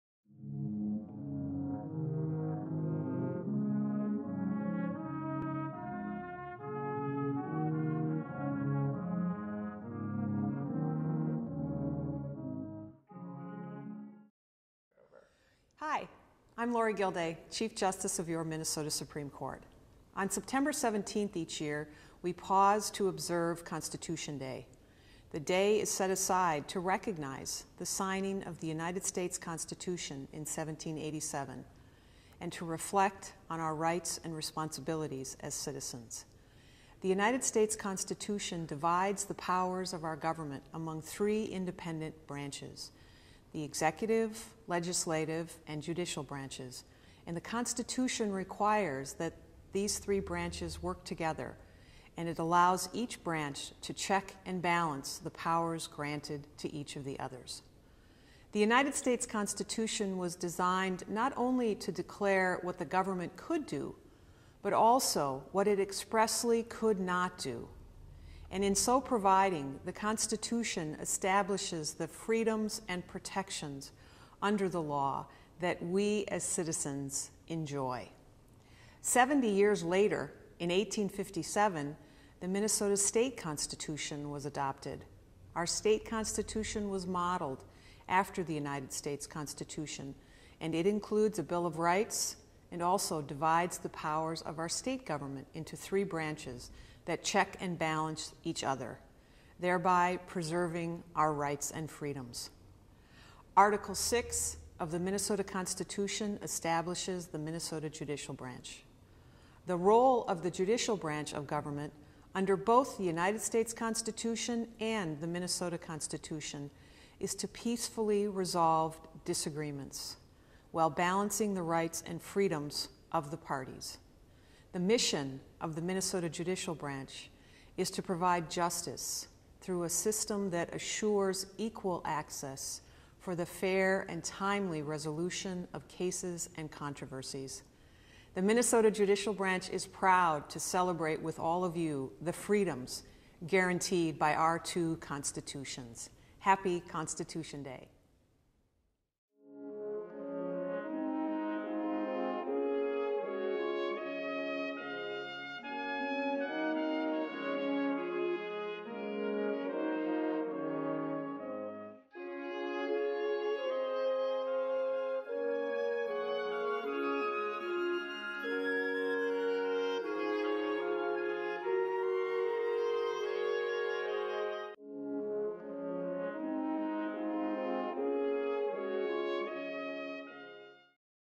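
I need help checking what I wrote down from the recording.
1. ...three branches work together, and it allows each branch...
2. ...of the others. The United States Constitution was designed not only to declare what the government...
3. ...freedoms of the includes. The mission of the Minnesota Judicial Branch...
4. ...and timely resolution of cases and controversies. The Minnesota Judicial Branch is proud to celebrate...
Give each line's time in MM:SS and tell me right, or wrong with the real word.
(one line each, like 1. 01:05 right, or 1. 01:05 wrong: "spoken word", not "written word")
1. 00:49 right
2. 00:56 right
3. 02:02 wrong: "parties", not "includes"
4. 02:14 right.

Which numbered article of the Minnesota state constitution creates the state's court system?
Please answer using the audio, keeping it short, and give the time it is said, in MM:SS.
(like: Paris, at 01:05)
Article 6, at 01:43.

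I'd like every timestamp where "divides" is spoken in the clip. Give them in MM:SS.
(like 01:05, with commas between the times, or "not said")
00:38, 01:33.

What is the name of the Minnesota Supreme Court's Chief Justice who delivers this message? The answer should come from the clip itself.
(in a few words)
Lorie Gildea.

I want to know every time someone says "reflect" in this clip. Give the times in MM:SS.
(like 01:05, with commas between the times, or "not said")
00:32.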